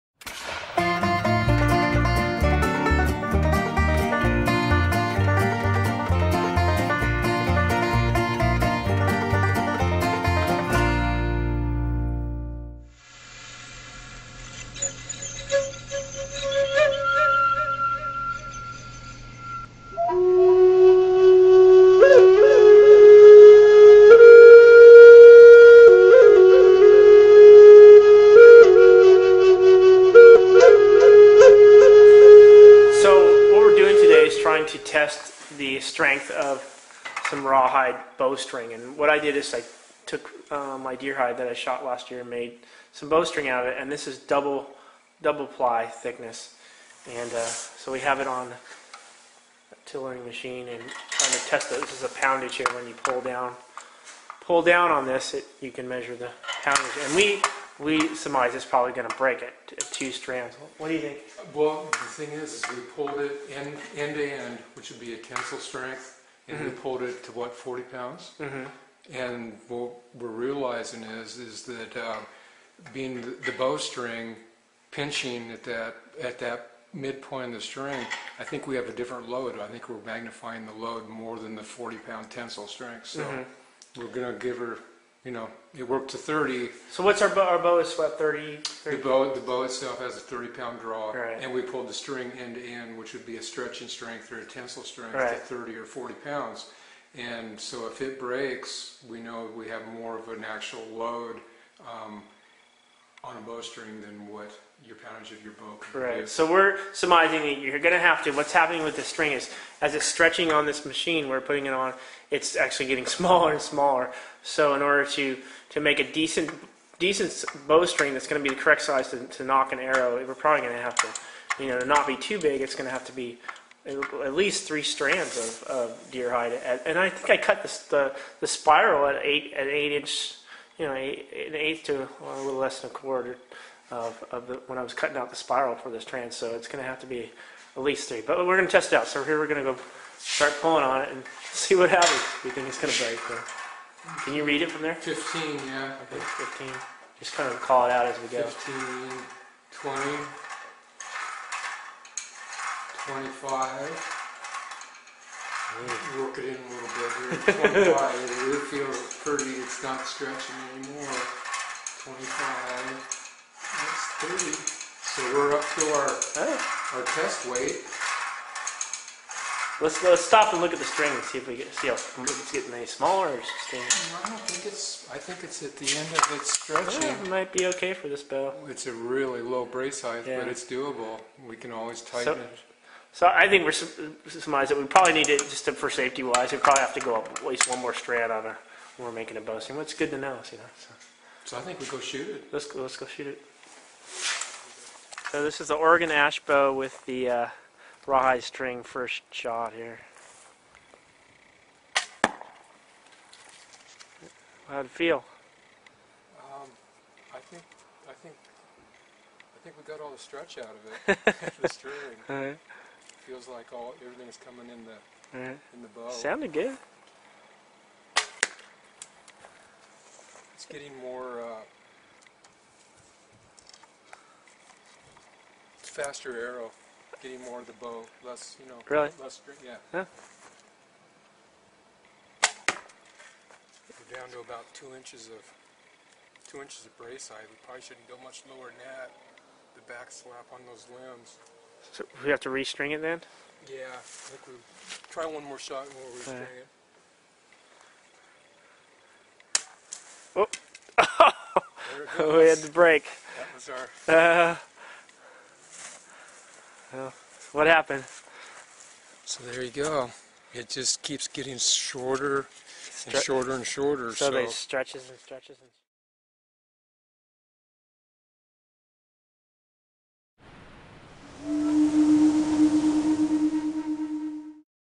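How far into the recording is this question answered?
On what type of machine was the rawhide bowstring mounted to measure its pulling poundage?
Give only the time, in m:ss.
0:49.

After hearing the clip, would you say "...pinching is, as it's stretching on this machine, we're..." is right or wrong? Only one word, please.
wrong.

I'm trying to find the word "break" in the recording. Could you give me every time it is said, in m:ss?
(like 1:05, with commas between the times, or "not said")
0:59, 1:38, 2:23, 4:12.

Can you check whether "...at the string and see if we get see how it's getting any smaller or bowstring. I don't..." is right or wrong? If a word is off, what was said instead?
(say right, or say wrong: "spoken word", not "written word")
wrong: "staying", not "bowstring".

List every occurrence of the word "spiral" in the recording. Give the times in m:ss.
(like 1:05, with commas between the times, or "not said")
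2:08, 2:15.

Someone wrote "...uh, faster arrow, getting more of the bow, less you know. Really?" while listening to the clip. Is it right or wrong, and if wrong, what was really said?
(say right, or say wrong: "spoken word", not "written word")
right.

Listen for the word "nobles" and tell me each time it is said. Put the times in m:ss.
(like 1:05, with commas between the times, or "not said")
not said.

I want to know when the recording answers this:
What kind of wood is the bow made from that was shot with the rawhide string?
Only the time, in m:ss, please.
3:15.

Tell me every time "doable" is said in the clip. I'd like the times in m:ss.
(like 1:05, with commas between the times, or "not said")
3:00.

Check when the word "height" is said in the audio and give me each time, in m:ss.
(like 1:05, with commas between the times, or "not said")
3:00, 3:57.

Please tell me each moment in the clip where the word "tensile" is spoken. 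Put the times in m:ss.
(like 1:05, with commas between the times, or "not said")
1:05, 1:22, 1:34.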